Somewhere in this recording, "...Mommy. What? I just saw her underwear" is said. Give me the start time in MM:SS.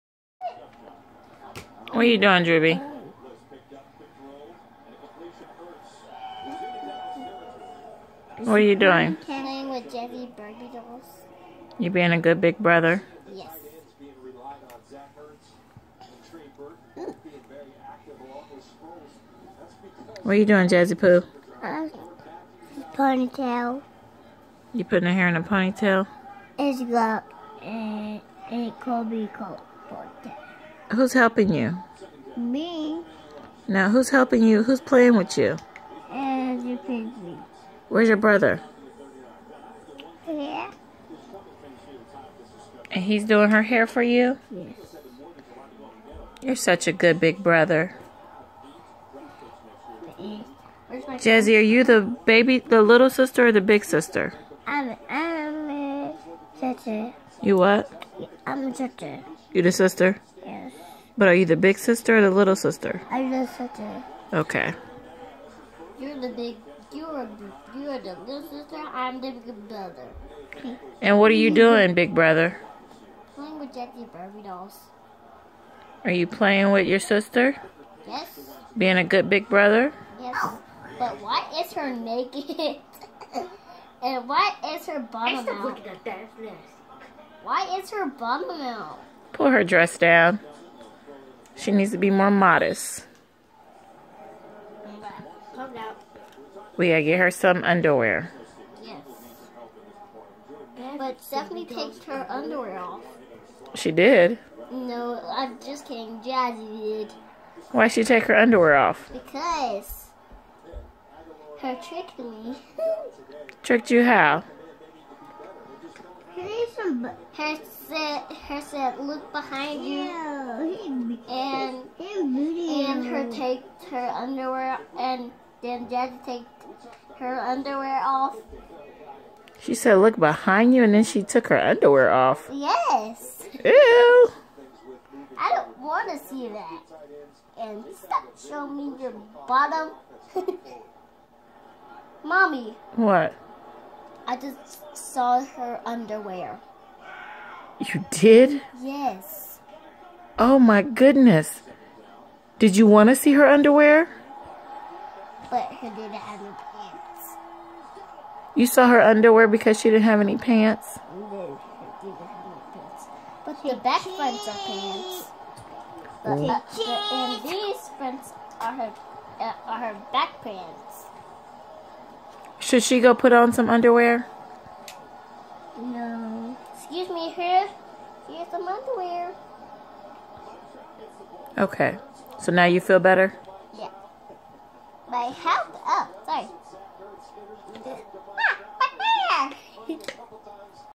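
02:22.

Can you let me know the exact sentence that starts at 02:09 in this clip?
She said, "Look behind you," and then she took her underwear off.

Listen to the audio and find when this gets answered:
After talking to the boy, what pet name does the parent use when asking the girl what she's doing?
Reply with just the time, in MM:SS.
00:20.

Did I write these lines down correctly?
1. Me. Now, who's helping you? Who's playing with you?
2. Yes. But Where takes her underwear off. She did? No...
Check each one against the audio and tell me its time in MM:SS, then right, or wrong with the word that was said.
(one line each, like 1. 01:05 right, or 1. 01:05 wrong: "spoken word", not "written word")
1. 00:32 right
2. 01:38 wrong: "Stephanie", not "Where".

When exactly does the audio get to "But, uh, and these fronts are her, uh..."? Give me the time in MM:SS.
02:46.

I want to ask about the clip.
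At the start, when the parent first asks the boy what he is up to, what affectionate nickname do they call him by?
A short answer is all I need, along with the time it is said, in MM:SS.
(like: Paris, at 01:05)
Drewby, at 00:02.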